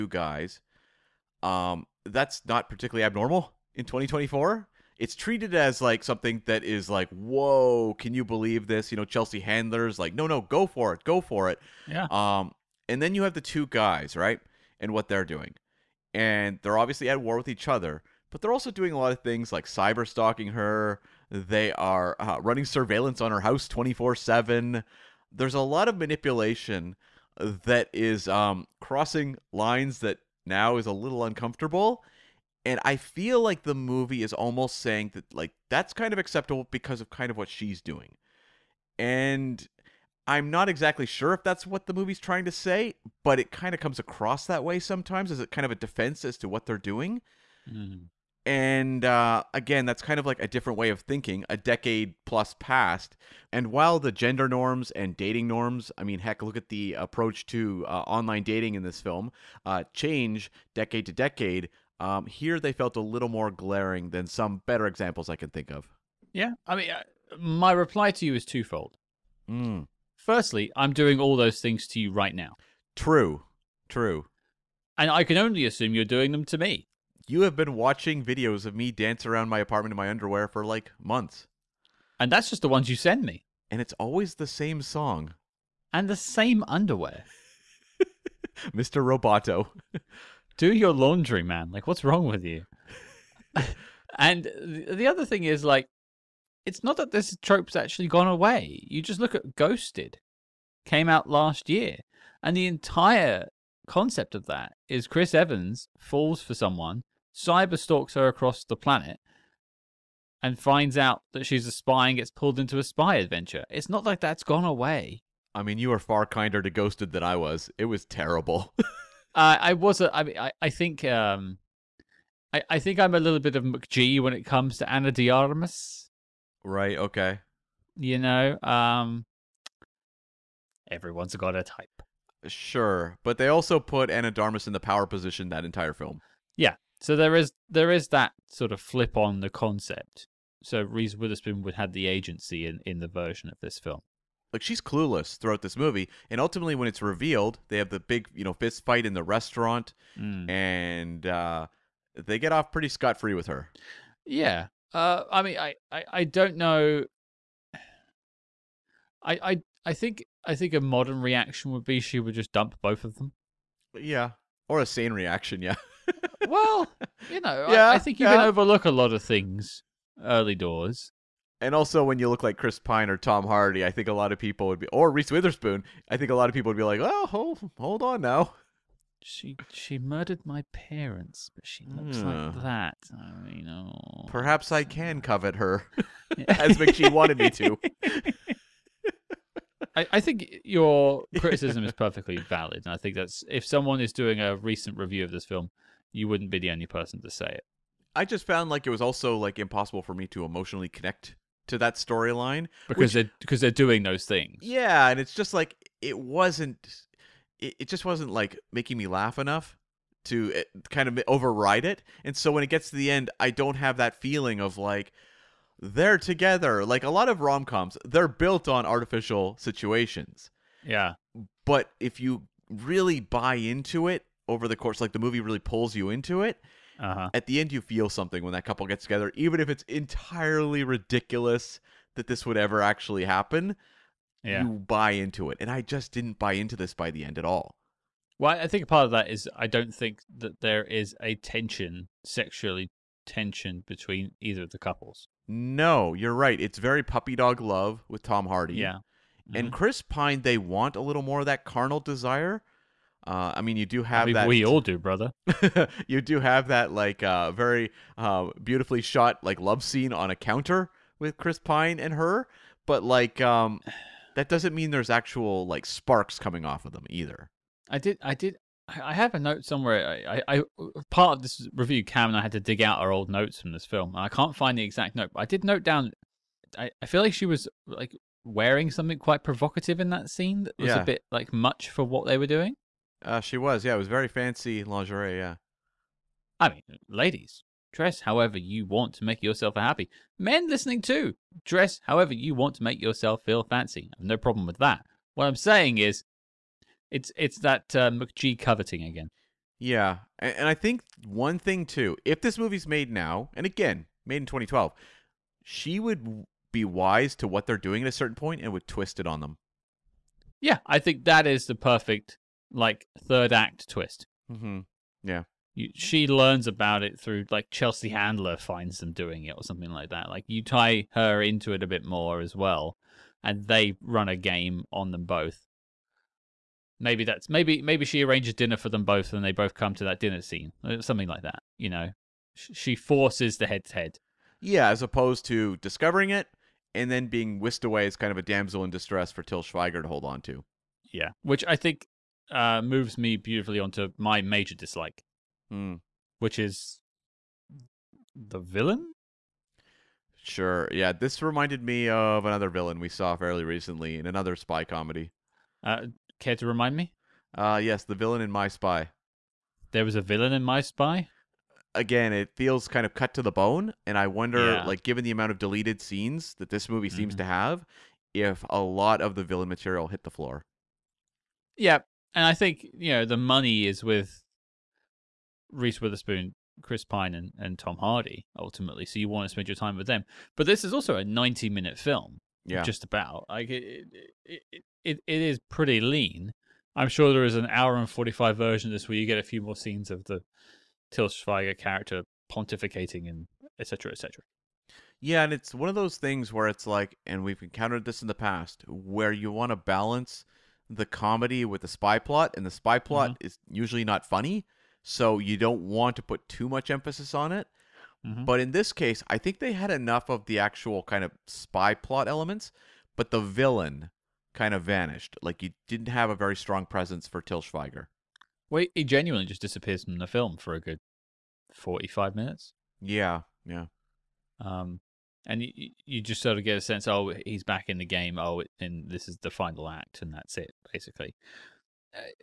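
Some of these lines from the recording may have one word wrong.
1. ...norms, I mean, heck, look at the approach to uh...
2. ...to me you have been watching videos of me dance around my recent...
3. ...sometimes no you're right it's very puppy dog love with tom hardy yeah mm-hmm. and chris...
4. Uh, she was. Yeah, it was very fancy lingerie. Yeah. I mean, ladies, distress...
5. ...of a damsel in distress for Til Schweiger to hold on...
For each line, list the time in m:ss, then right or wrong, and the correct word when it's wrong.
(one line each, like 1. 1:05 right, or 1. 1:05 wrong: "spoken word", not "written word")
1. 0:55 right
2. 1:16 wrong: "apartment", not "recent"
3. 4:04 wrong: "couples", not "sometimes"
4. 4:43 wrong: "dress", not "distress"
5. 5:38 right.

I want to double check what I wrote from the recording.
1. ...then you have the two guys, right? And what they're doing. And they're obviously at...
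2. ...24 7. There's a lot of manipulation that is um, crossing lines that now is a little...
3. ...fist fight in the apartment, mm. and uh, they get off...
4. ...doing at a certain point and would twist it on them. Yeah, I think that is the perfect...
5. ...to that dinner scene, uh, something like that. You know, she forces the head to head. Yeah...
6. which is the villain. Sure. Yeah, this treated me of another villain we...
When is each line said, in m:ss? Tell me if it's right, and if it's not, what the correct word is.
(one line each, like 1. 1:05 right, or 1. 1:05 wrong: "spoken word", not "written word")
1. 0:12 right
2. 0:23 right
3. 2:28 wrong: "restaurant", not "apartment"
4. 5:07 right
5. 5:29 right
6. 5:46 wrong: "reminded", not "treated".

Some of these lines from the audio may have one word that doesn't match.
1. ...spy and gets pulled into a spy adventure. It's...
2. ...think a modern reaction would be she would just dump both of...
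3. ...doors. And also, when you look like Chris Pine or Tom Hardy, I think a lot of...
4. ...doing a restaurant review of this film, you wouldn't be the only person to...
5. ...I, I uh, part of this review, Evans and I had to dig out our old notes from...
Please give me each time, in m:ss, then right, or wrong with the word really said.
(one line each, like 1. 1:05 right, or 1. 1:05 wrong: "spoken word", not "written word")
1. 1:51 right
2. 2:40 right
3. 2:50 right
4. 3:14 wrong: "recent", not "restaurant"
5. 4:30 wrong: "Cam", not "Evans".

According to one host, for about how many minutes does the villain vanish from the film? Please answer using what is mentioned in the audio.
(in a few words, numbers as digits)
45 minutes.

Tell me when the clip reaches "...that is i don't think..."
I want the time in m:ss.
3:59.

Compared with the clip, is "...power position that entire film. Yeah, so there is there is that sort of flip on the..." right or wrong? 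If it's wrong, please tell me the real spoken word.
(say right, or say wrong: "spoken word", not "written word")
right.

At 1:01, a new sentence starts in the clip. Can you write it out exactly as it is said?
Um, here they felt a little more glaring than some better examples I can think of.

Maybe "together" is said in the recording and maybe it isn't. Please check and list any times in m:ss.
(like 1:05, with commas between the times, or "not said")
3:36, 3:49.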